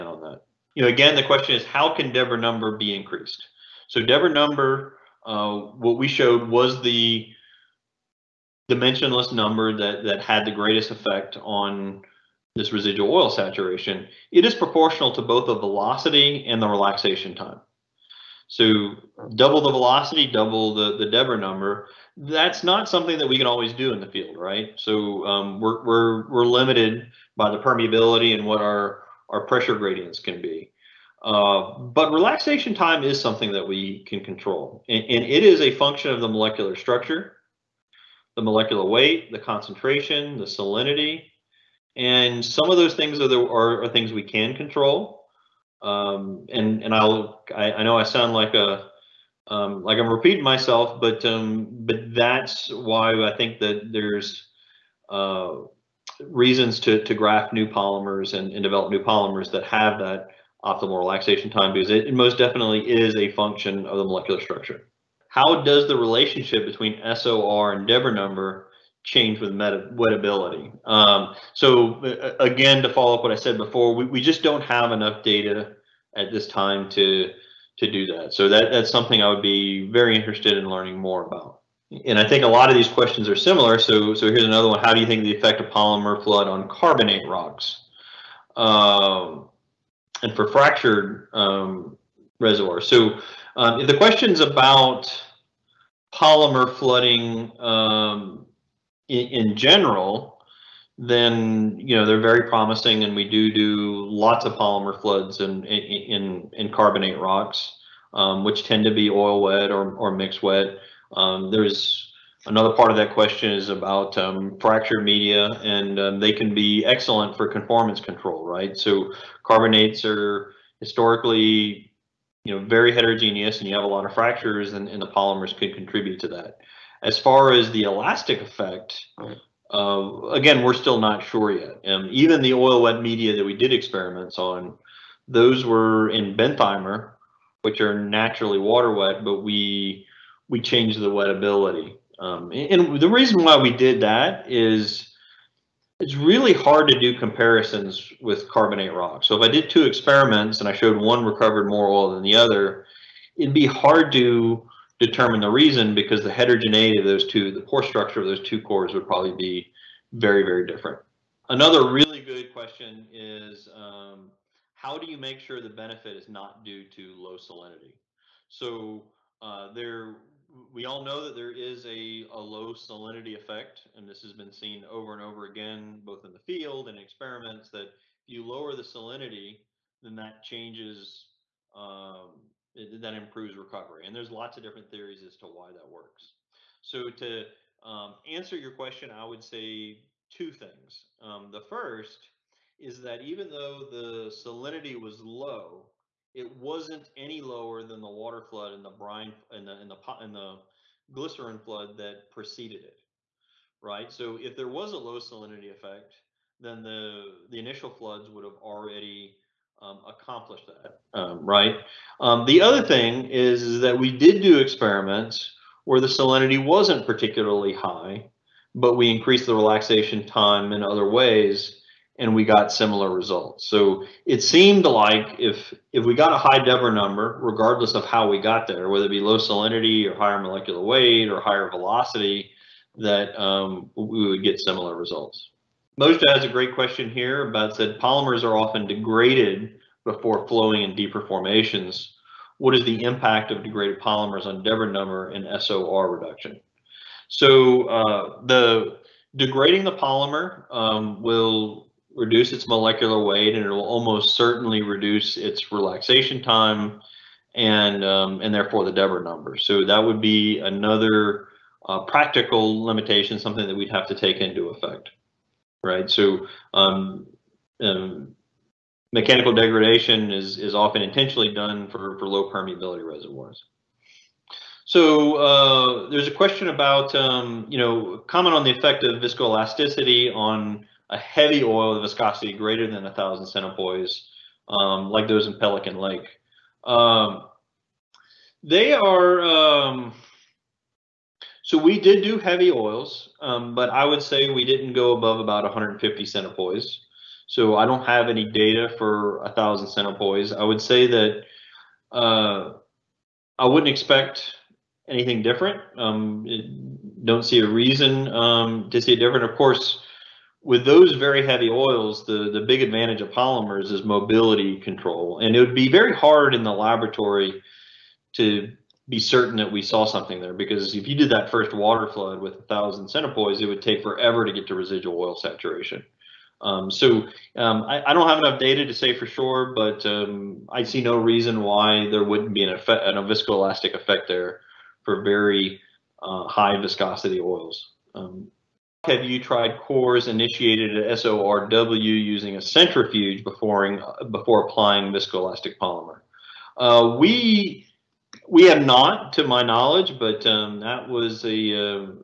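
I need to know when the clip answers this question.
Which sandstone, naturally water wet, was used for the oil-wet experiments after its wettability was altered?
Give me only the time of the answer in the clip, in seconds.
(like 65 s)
136 s.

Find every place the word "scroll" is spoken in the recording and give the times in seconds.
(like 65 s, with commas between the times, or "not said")
not said.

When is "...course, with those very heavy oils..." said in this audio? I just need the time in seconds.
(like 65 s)
309 s.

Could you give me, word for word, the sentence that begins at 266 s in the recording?
So um, um, mechanical degradation is is often intentionally done for for low permeability reservoirs.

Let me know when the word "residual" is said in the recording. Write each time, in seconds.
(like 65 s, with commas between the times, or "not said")
12 s, 324 s.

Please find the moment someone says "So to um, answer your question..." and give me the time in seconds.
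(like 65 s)
186 s.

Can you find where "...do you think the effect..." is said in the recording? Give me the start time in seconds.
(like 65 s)
84 s.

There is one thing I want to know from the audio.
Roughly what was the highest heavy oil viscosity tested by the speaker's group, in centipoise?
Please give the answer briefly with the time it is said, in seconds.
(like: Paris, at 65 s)
150 centipoise, at 295 s.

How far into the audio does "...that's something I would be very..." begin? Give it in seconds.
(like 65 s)
78 s.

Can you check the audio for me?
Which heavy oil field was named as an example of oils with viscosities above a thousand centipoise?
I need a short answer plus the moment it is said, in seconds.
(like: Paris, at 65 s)
Pelican Lake, at 285 s.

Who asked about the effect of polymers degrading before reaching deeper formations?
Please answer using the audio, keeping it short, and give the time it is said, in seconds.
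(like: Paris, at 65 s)
Moshe, at 235 s.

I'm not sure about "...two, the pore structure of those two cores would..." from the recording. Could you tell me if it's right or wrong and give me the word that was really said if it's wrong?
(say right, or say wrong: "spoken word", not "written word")
right.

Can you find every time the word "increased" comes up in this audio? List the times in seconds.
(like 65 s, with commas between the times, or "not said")
2 s, 219 s.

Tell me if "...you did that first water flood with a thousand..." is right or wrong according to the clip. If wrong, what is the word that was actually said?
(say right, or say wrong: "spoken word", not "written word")
right.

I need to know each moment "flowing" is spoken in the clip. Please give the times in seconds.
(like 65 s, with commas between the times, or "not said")
240 s.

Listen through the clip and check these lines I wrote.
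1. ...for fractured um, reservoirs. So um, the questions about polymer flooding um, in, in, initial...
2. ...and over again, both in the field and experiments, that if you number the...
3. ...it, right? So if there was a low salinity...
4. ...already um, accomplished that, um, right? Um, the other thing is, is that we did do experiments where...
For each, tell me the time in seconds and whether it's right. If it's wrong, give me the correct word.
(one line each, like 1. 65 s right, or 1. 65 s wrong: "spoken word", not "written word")
1. 90 s wrong: "general", not "initial"
2. 175 s wrong: "lower", not "number"
3. 202 s right
4. 208 s right.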